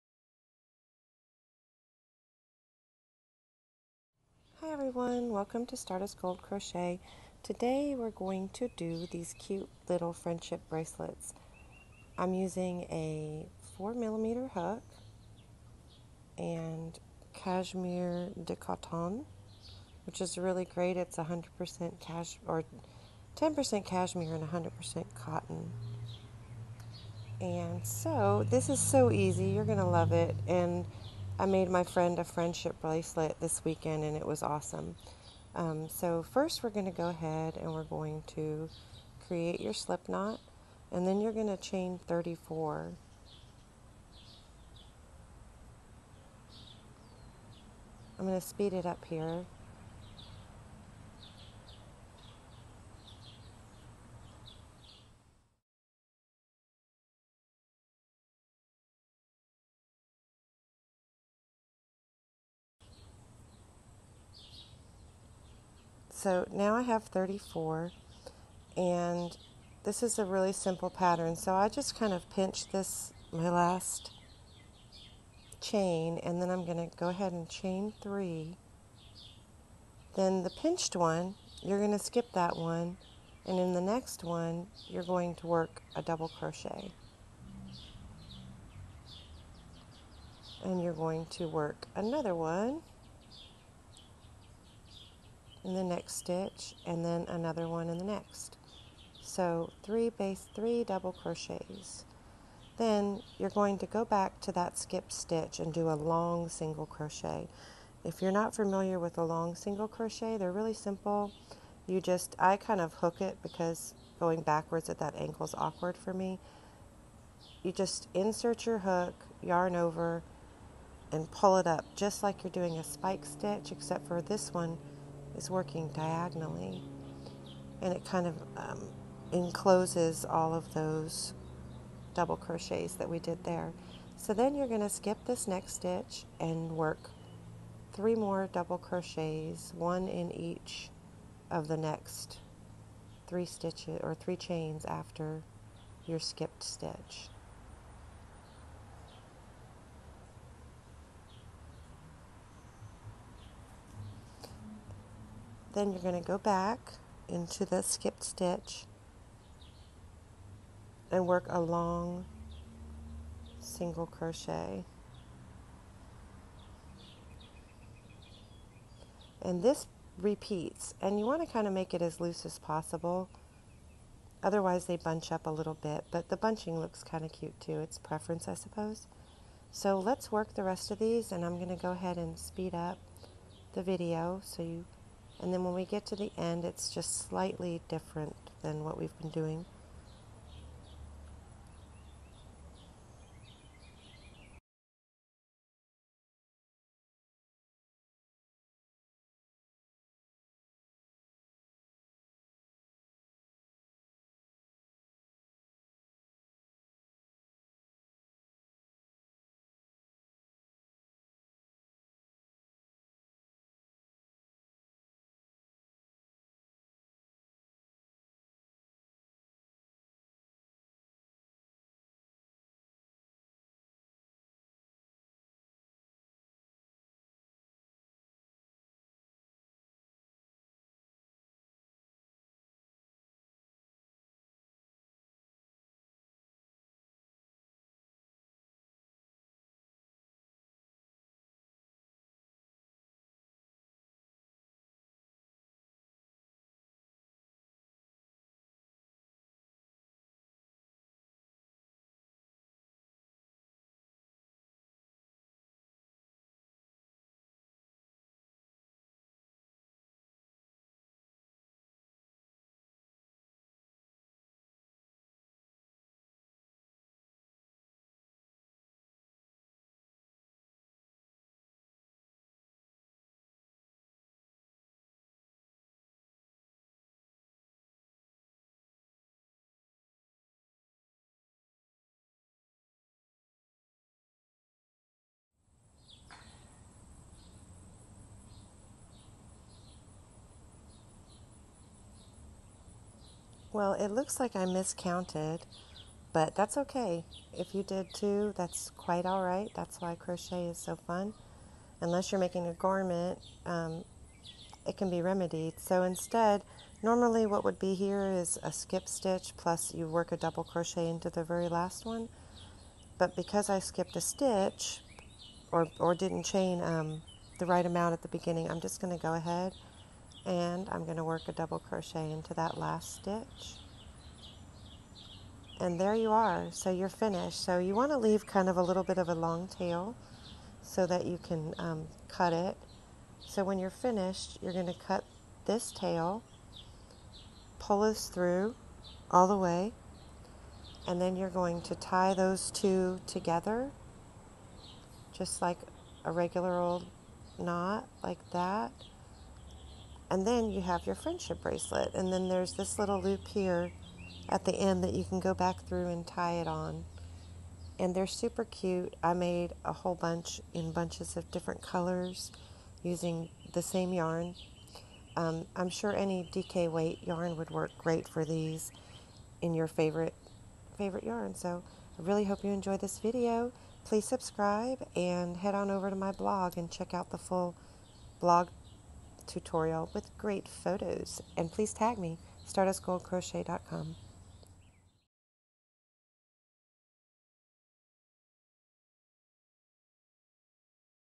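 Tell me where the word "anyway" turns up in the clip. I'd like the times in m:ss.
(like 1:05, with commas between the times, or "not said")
not said.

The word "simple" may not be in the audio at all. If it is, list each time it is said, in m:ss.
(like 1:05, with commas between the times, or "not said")
1:10, 1:50.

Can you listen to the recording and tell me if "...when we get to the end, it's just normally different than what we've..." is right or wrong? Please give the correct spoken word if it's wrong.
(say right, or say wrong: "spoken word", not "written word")
wrong: "slightly", not "normally".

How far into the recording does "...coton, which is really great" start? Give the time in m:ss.
0:18.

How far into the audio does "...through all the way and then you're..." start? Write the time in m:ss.
5:38.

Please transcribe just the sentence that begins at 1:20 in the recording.
Then the pinched one, you're going to skip that one, and in the next one, you're going to work a double crochet.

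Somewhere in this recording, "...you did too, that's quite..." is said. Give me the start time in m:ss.
4:57.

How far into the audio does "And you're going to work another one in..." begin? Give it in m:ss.
1:30.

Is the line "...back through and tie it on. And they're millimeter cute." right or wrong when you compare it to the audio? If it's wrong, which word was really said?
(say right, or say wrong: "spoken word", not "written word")
wrong: "super", not "millimeter".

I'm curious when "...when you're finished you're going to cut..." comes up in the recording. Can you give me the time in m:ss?
5:33.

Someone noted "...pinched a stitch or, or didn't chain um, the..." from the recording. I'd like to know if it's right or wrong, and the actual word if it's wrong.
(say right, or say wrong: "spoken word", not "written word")
wrong: "skipped", not "pinched".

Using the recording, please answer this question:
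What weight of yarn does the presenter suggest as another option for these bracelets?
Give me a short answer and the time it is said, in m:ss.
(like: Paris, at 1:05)
DK weight, at 6:06.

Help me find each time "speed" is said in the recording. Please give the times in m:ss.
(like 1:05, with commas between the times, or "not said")
0:48, 3:02.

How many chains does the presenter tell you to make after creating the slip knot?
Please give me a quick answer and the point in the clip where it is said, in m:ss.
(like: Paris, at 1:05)
34, at 0:41.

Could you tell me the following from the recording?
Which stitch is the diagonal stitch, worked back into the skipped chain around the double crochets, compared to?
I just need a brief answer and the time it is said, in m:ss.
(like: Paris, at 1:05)
spike stitch, at 2:02.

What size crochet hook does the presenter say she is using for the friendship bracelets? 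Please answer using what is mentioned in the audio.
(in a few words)
4 millimeter.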